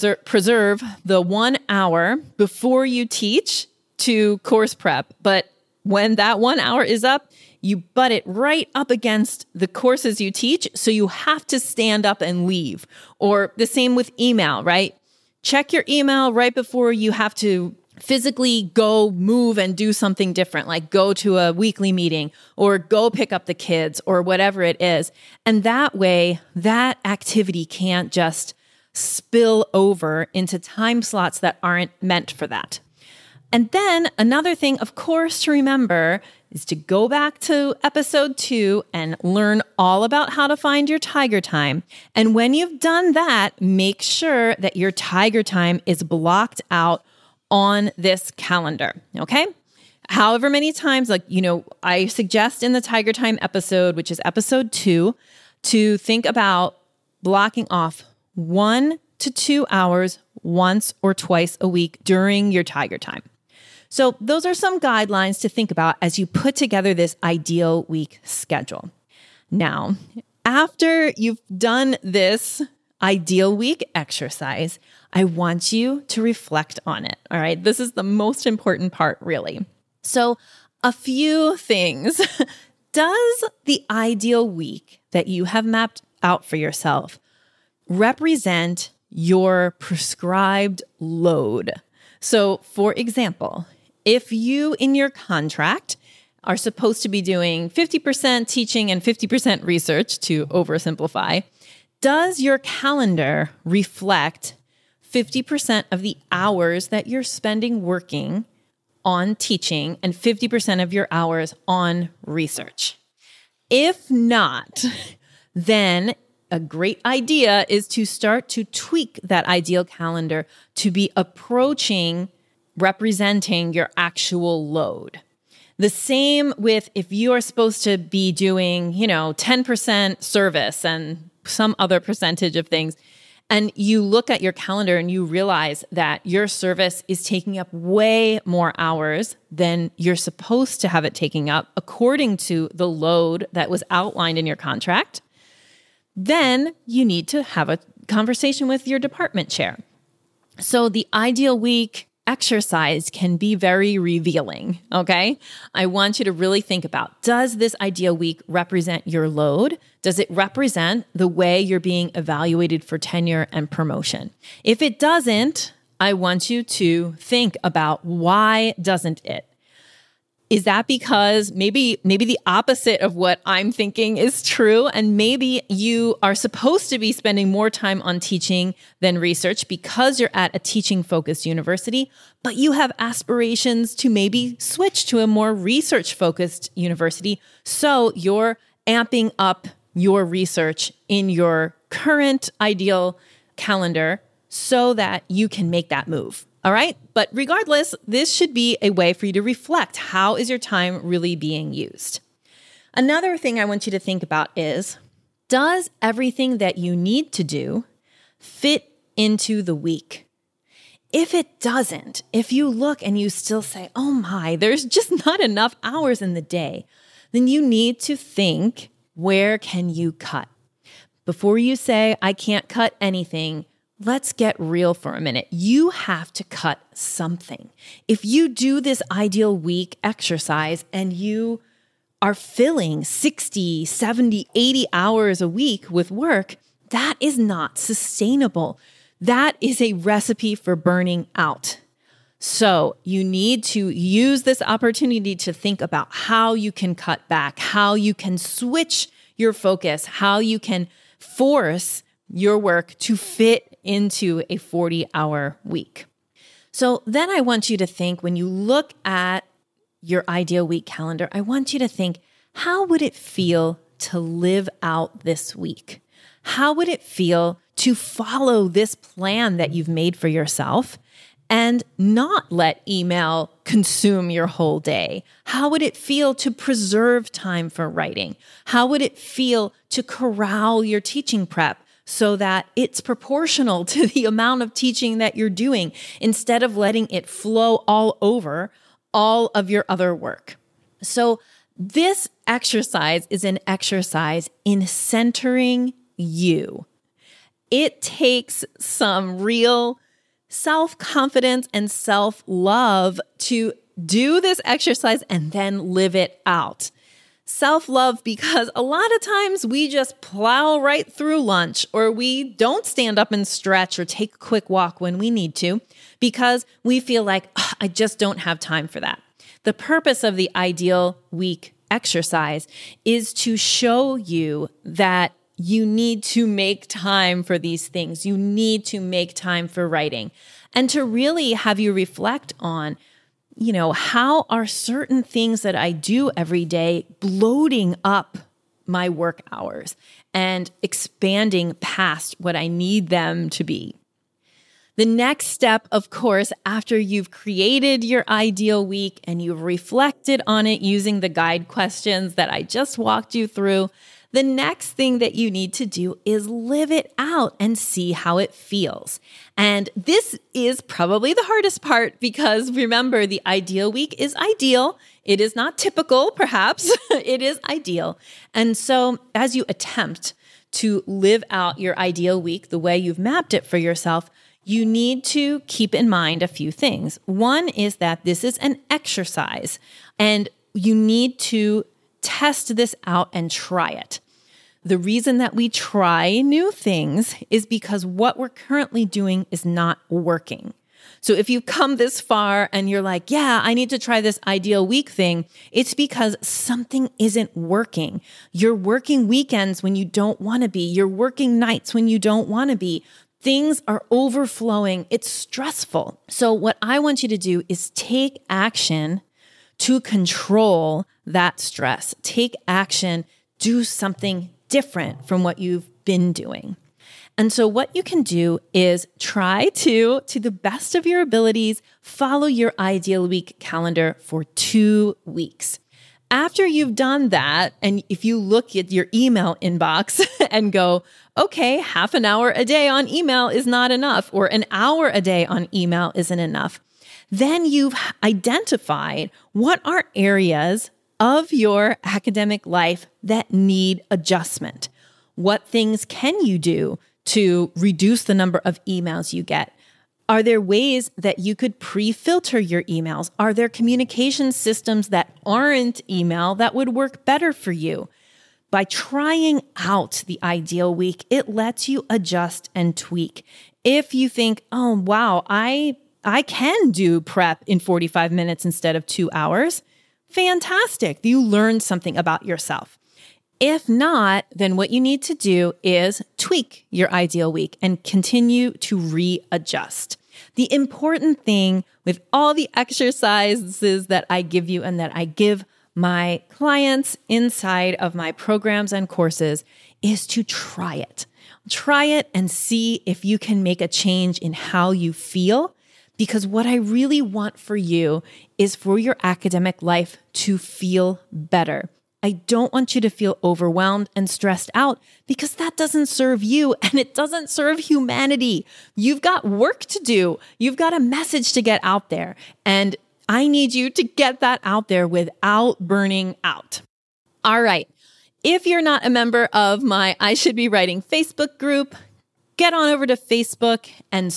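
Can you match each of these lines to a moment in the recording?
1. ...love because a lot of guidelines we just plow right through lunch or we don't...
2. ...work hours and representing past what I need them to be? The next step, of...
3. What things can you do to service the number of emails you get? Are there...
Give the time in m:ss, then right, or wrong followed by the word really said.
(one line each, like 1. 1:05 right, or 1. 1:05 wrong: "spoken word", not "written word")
1. 5:07 wrong: "times", not "guidelines"
2. 5:39 wrong: "expanding", not "representing"
3. 7:25 wrong: "reduce", not "service".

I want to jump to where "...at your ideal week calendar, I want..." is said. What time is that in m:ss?
4:19.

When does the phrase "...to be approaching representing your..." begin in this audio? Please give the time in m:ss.
2:00.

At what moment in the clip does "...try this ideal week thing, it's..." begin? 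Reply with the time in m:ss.
6:33.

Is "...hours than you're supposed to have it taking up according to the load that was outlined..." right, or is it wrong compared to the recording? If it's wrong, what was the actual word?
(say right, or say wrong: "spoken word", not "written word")
right.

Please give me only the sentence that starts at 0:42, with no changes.
And when you've done that, make sure that your tiger time is blocked out on this calendar.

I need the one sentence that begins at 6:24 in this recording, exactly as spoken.
The reason that we try new things is because what we're currently doing is not working.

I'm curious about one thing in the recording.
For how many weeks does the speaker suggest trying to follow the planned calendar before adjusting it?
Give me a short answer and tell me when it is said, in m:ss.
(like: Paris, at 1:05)
2, at 7:04.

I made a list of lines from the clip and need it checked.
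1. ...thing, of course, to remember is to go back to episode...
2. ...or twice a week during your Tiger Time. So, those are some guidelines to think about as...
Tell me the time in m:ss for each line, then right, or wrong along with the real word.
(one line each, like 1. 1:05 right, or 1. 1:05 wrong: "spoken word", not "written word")
1. 0:34 right
2. 1:01 right.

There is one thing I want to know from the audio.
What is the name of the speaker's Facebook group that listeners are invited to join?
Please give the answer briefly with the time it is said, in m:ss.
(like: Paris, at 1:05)
I Should Be Writing, at 8:40.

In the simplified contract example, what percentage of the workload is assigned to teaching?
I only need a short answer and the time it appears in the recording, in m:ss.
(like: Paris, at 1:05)
50%, at 1:37.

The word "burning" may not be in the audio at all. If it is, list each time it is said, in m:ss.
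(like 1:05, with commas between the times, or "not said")
4:00, 8:35.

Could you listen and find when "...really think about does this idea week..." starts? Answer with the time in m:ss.
2:36.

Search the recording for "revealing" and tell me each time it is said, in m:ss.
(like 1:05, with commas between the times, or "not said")
2:33.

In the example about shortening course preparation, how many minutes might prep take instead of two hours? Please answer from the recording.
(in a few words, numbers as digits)
45.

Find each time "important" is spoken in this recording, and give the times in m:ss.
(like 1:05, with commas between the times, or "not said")
1:18, 8:00.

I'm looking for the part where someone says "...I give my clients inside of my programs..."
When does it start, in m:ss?
8:05.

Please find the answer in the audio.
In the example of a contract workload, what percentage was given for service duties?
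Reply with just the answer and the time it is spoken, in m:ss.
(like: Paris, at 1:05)
10%, at 2:09.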